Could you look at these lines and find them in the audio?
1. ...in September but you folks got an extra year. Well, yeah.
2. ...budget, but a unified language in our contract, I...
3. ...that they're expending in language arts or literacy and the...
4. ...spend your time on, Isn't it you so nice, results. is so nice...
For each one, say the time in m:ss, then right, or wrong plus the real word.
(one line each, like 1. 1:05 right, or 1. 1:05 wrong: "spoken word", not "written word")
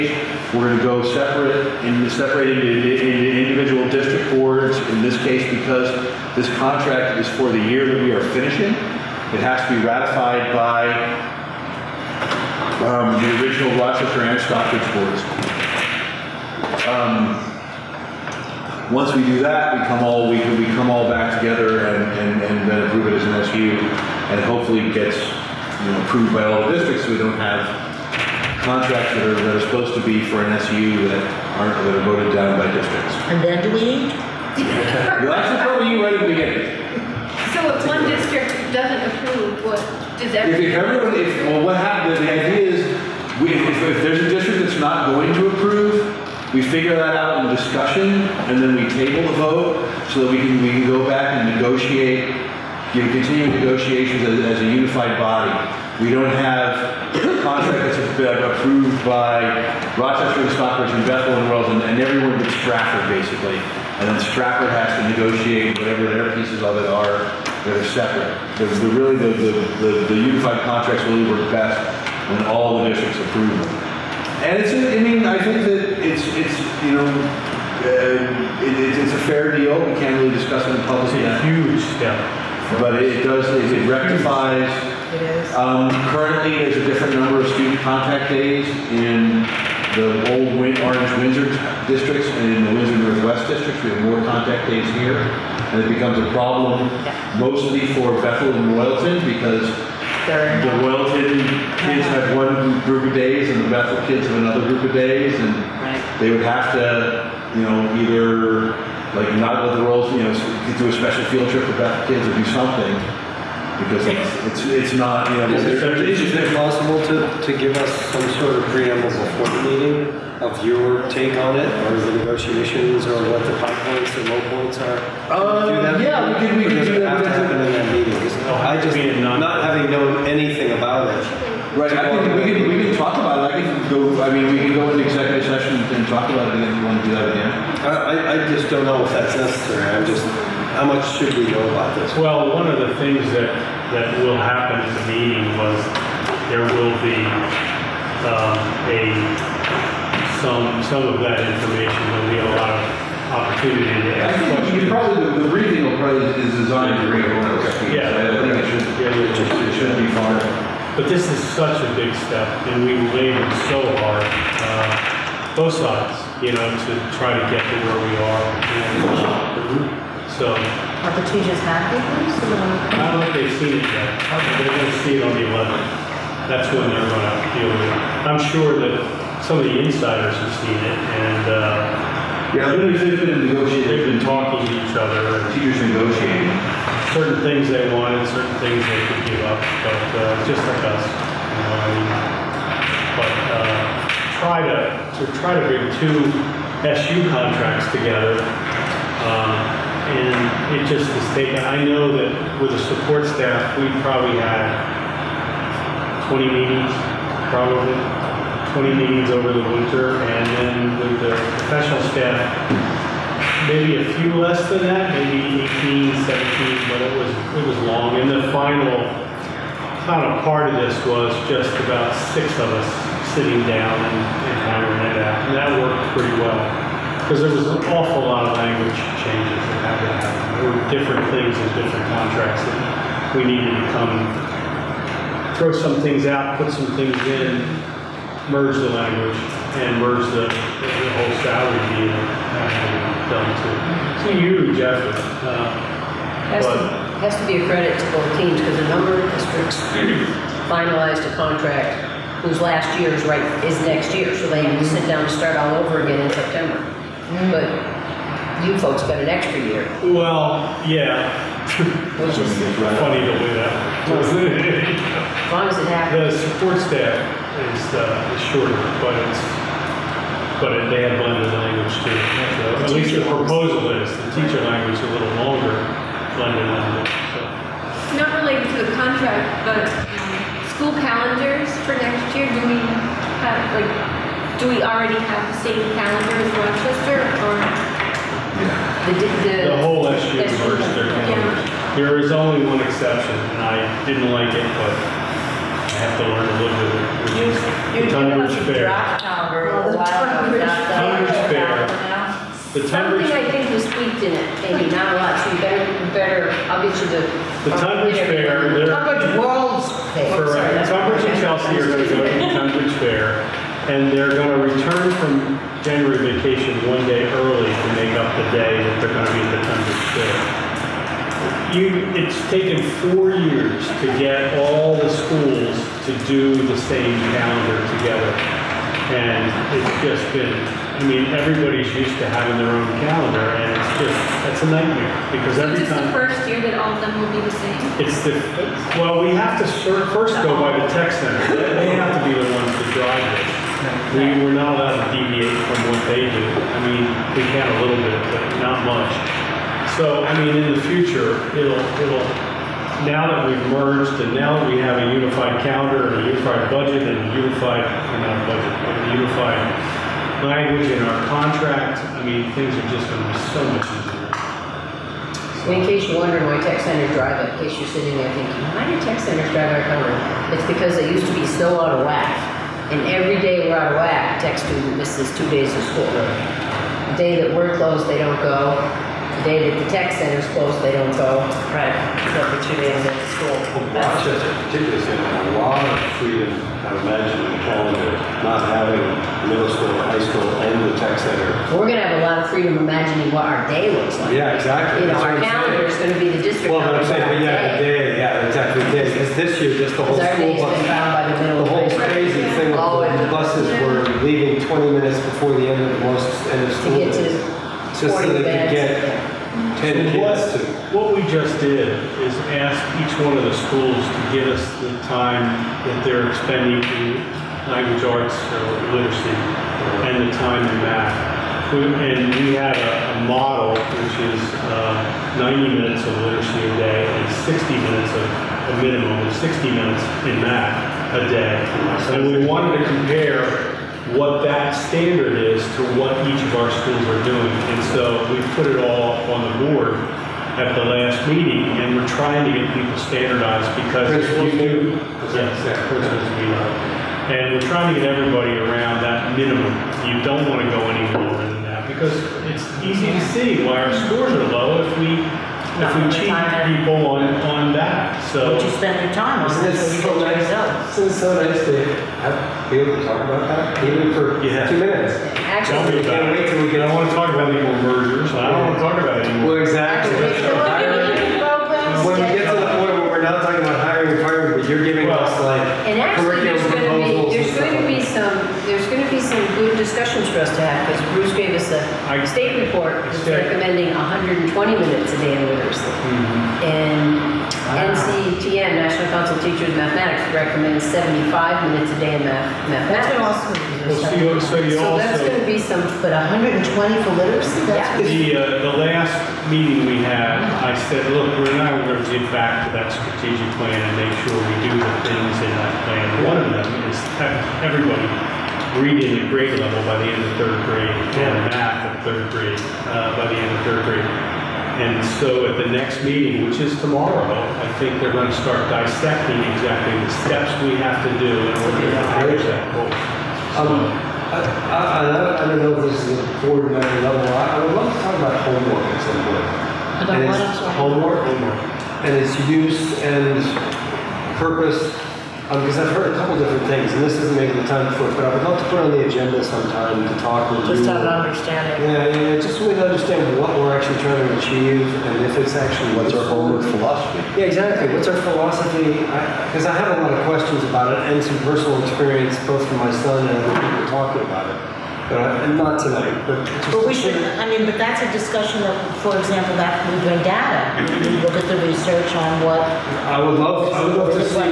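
1. 4:16 right
2. 5:58 right
3. 6:55 right
4. 7:38 right.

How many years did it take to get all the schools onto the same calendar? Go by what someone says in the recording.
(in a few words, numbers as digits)
4.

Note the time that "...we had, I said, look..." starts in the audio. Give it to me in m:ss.
8:19.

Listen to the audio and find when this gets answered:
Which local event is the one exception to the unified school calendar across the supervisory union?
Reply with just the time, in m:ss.
5:08.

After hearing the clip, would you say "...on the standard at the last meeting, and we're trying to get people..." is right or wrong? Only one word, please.
wrong.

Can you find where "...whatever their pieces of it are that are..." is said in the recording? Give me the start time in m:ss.
1:05.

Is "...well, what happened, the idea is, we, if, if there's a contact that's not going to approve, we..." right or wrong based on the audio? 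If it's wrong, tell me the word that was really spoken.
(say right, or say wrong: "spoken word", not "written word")
wrong: "district", not "contact".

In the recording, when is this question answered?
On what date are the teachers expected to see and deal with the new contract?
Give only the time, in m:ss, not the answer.
2:55.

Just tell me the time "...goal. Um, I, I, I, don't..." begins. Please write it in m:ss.
8:42.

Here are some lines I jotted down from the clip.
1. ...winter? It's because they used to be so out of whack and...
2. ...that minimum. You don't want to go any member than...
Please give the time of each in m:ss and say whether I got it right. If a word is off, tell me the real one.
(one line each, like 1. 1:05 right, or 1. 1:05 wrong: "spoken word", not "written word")
1. 6:09 wrong: "cover", not "winter"
2. 7:29 wrong: "lower", not "member".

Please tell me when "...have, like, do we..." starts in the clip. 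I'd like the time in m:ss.
4:43.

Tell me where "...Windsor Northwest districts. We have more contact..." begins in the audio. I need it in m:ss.
1:32.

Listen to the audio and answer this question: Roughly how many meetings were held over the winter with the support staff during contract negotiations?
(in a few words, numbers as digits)
20.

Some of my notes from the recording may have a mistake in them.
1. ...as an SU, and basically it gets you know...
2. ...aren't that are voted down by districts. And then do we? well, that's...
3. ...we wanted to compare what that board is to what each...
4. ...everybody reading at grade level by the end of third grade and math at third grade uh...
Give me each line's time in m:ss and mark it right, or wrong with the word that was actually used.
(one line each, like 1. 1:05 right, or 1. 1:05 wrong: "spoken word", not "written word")
1. 0:23 wrong: "hopefully", not "basically"
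2. 0:31 right
3. 7:12 wrong: "standard", not "board"
4. 8:27 right.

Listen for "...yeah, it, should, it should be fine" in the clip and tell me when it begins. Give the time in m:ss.
2:38.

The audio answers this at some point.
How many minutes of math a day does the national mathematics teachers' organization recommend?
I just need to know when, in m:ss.
8:10.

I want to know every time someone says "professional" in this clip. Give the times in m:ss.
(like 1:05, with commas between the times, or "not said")
3:31.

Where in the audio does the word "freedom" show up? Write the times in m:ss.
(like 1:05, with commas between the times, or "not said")
6:26, 6:32.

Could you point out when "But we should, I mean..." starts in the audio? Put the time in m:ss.
9:16.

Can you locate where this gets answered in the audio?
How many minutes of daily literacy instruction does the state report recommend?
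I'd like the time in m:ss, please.
8:03.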